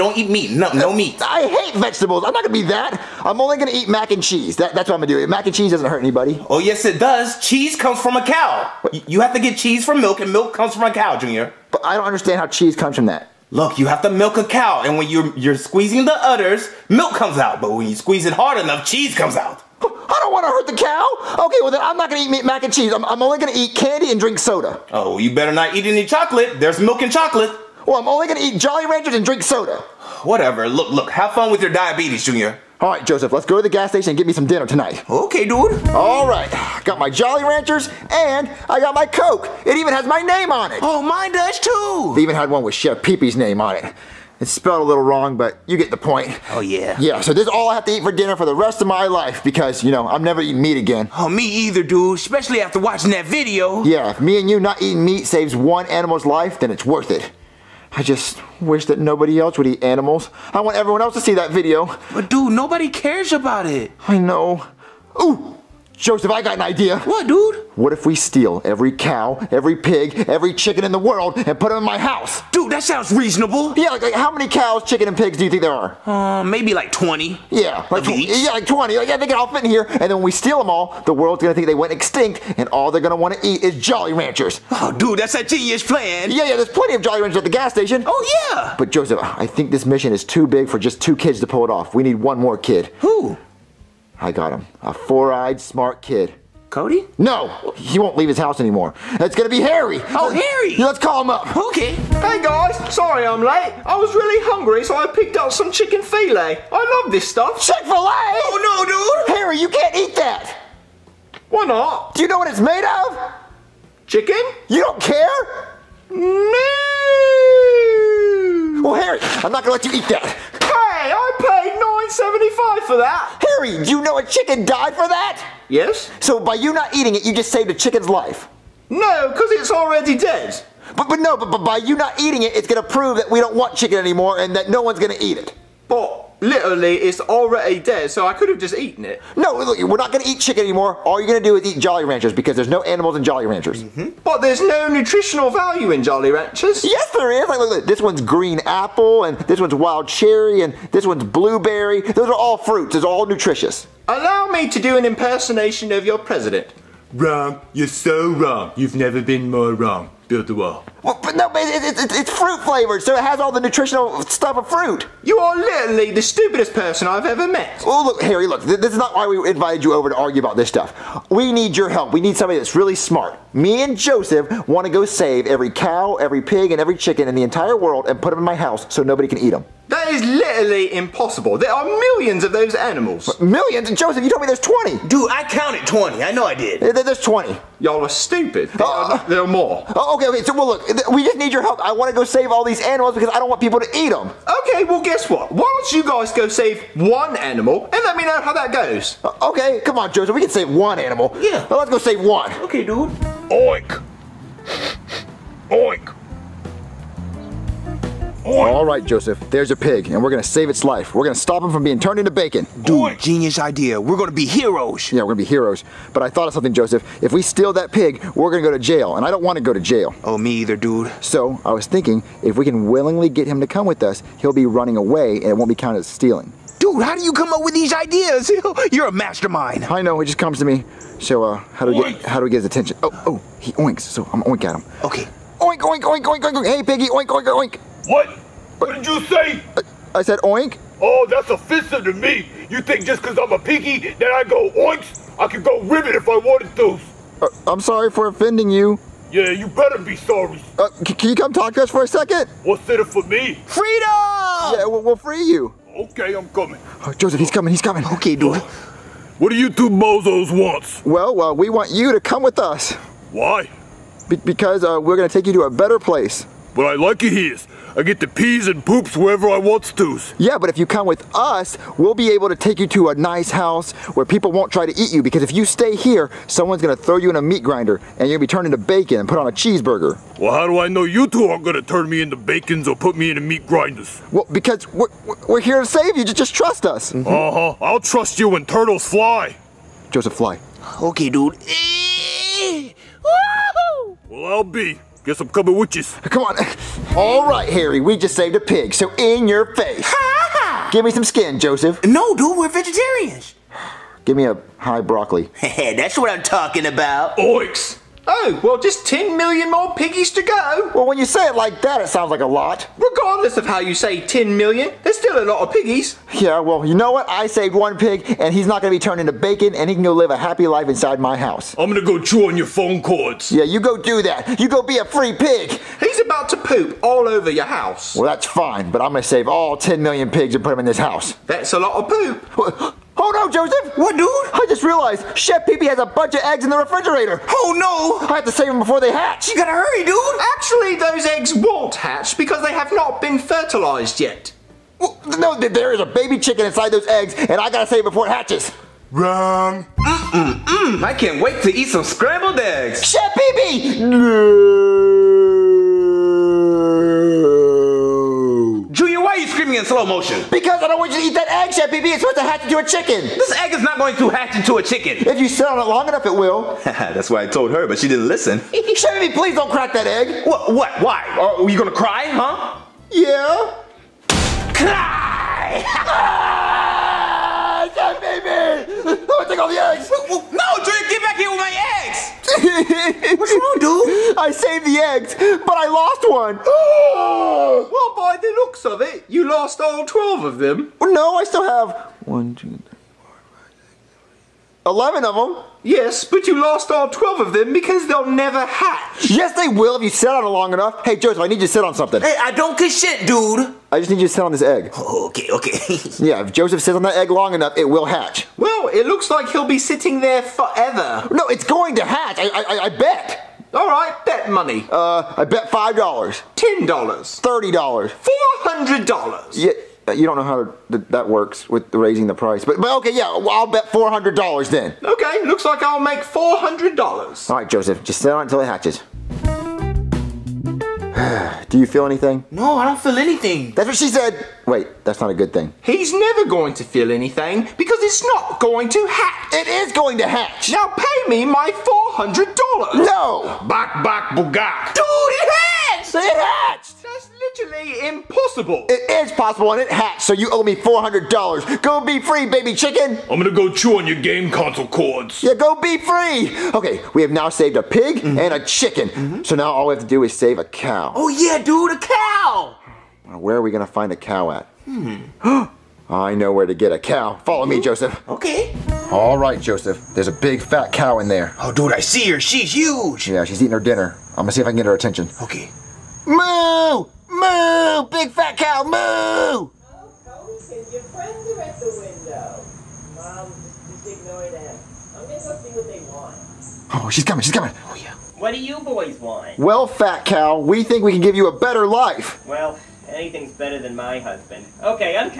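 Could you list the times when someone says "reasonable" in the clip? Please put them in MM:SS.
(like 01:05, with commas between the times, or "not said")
01:13.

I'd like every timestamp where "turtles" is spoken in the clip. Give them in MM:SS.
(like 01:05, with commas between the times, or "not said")
04:48.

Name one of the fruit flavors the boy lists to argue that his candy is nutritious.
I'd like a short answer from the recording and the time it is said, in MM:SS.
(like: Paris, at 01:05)
Green apple, at 02:28.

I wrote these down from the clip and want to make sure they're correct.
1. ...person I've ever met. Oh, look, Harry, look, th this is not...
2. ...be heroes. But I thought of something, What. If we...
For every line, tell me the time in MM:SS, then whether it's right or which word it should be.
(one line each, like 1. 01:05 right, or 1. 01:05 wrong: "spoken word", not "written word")
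1. 02:46 right
2. 03:35 wrong: "Joseph", not "What".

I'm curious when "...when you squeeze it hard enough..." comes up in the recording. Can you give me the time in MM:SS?
00:17.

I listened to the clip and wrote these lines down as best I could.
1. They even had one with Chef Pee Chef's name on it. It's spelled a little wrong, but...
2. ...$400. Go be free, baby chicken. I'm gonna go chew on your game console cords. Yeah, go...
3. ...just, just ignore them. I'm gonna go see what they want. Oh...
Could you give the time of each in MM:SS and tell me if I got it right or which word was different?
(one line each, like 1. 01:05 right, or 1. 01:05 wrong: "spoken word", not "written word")
1. 00:42 wrong: "Pee", not "Chef"
2. 07:30 right
3. 08:03 right.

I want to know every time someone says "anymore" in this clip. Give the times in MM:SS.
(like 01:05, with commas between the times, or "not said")
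01:38, 02:13, 02:20.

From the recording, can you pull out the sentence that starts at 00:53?
Yeah, if me and you not eating meat saves one animal's life, then it's worth it.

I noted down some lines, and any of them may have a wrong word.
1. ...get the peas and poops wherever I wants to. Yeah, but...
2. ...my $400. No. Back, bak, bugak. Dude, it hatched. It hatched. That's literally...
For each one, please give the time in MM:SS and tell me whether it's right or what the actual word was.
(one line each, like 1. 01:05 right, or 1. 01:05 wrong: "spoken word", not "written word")
1. 04:28 right
2. 07:21 right.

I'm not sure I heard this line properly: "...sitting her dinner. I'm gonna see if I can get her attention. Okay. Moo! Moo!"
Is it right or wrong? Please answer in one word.
wrong.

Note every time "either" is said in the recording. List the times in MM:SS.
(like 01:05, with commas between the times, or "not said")
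00:51, 03:40.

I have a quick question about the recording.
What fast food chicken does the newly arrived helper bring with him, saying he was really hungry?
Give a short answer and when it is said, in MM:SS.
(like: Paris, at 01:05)
Chick-fil-A, at 01:47.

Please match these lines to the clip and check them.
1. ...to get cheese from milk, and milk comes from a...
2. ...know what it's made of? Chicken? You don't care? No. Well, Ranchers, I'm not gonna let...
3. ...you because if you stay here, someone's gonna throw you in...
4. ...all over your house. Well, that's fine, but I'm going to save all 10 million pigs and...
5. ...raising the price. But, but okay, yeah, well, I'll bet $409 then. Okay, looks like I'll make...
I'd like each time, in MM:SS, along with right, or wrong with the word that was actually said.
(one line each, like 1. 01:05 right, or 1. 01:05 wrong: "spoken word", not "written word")
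1. 00:09 right
2. 01:52 wrong: "Harry", not "Ranchers"
3. 04:35 right
4. 05:27 right
5. 07:01 wrong: "400", not "409".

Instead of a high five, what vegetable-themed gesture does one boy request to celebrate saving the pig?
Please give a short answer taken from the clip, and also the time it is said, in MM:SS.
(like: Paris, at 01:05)
High broccoli, at 05:04.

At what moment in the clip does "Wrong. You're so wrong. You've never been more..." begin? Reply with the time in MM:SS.
02:37.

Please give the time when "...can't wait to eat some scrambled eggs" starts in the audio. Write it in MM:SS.
05:51.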